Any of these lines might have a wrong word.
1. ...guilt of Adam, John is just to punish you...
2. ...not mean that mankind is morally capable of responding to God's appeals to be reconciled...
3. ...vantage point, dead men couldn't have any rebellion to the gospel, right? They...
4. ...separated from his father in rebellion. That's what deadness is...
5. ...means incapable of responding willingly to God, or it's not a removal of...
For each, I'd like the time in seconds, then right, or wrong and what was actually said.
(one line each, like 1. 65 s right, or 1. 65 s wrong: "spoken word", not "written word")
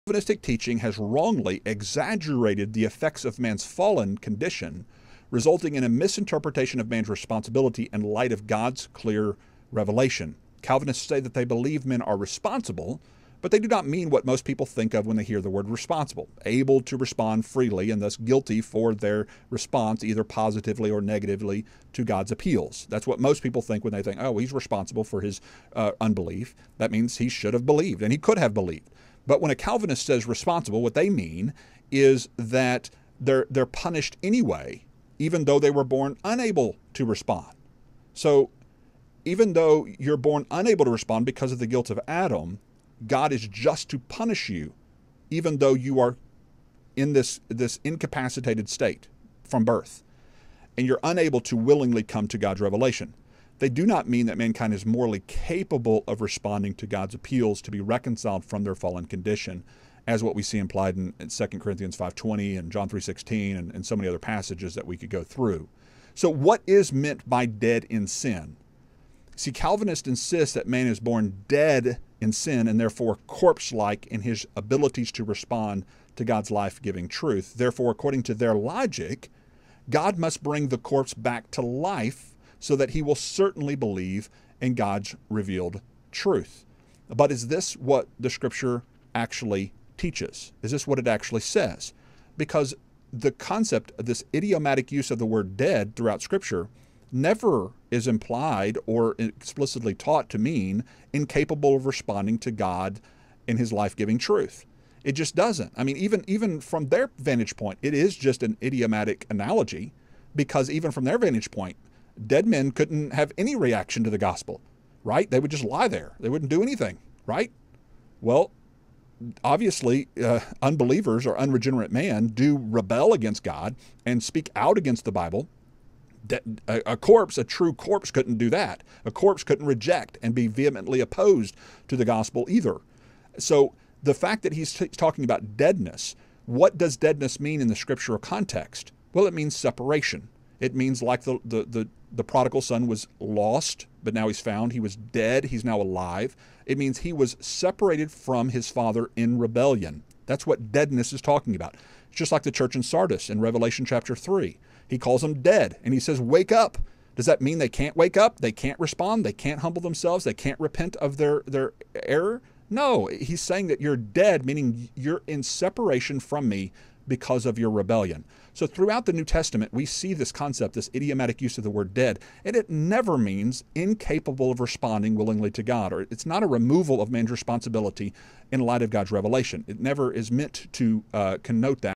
1. 41 s wrong: "God", not "John"
2. 53 s right
3. 111 s wrong: "reaction", not "rebellion"
4. 147 s right
5. 173 s right.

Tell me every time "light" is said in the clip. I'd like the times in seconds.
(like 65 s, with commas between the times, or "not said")
8 s, 178 s.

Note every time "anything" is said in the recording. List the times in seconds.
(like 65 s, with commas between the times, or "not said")
116 s.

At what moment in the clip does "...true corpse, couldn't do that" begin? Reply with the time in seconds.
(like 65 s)
127 s.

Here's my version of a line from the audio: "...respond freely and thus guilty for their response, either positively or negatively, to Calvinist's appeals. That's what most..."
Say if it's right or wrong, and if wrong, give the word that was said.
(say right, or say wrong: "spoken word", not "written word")
wrong: "God", not "Calvinist".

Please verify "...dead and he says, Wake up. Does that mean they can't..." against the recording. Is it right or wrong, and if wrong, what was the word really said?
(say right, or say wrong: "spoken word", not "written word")
right.